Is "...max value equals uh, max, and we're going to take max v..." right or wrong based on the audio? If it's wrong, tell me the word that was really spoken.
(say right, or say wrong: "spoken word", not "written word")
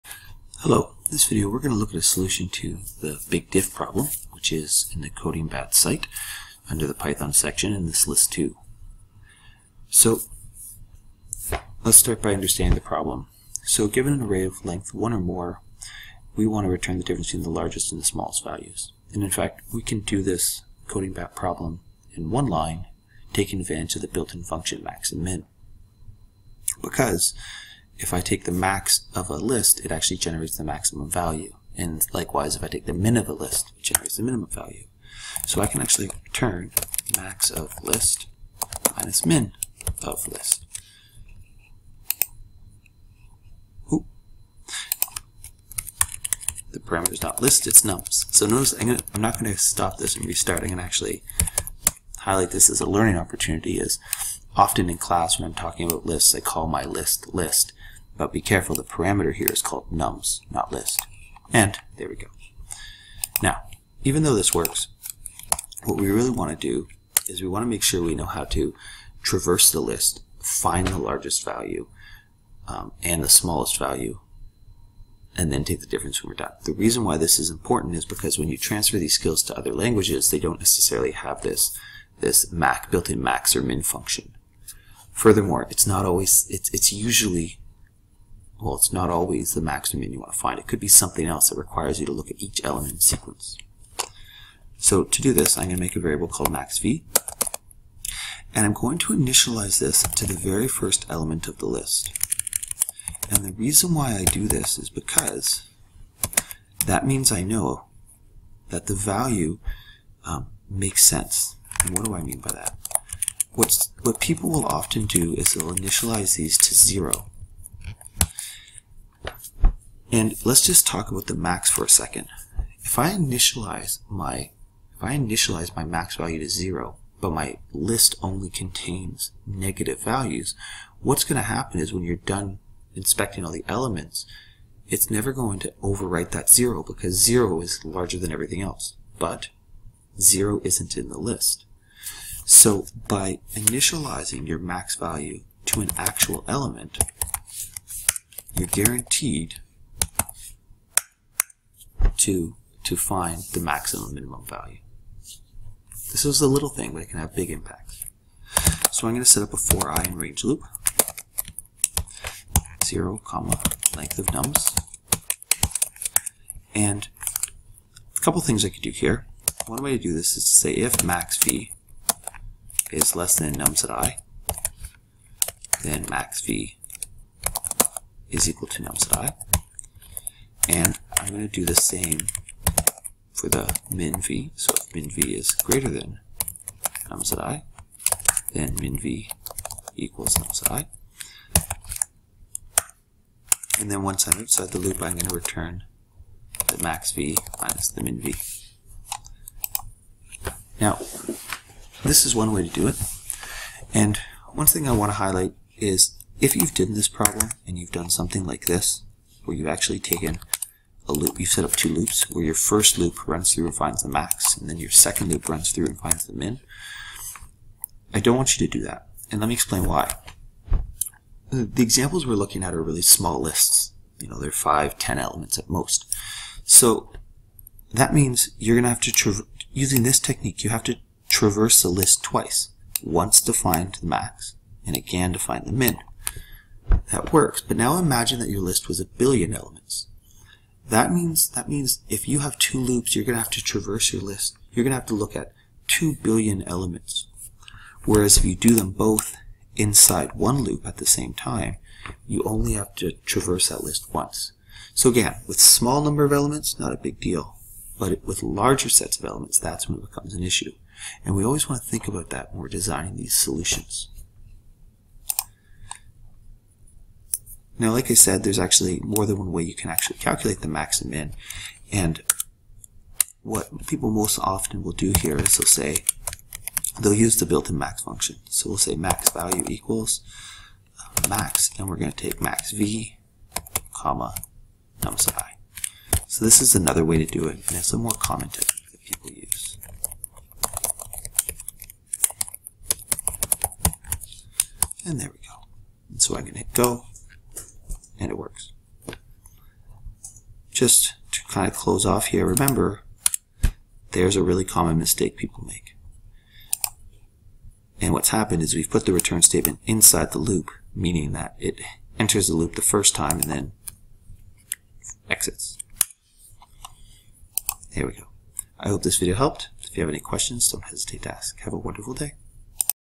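right.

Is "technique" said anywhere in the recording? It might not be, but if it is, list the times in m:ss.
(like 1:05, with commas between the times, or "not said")
3:50, 4:48.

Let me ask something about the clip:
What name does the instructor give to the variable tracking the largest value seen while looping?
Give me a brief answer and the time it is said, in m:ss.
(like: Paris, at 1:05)
maxv, at 1:36.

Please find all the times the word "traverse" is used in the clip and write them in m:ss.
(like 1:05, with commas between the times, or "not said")
1:09, 3:51, 4:03, 4:13.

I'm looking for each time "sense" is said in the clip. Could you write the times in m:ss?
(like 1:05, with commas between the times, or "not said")
1:51.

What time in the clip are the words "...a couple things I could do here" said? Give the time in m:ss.
2:48.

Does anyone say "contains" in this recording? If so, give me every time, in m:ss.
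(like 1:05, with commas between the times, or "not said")
2:08.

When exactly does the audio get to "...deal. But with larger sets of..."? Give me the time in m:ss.
4:17.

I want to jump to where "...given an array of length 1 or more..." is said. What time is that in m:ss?
0:13.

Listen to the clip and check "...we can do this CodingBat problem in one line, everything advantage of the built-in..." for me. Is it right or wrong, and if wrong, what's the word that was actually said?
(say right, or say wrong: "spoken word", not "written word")
wrong: "taking", not "everything".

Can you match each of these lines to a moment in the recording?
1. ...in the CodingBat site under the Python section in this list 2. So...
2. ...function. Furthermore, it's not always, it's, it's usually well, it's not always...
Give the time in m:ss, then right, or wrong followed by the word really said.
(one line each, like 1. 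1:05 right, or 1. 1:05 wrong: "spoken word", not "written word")
1. 0:04 right
2. 1:23 right.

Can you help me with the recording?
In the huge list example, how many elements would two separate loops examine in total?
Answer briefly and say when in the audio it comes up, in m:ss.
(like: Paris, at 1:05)
2 billion, at 4:05.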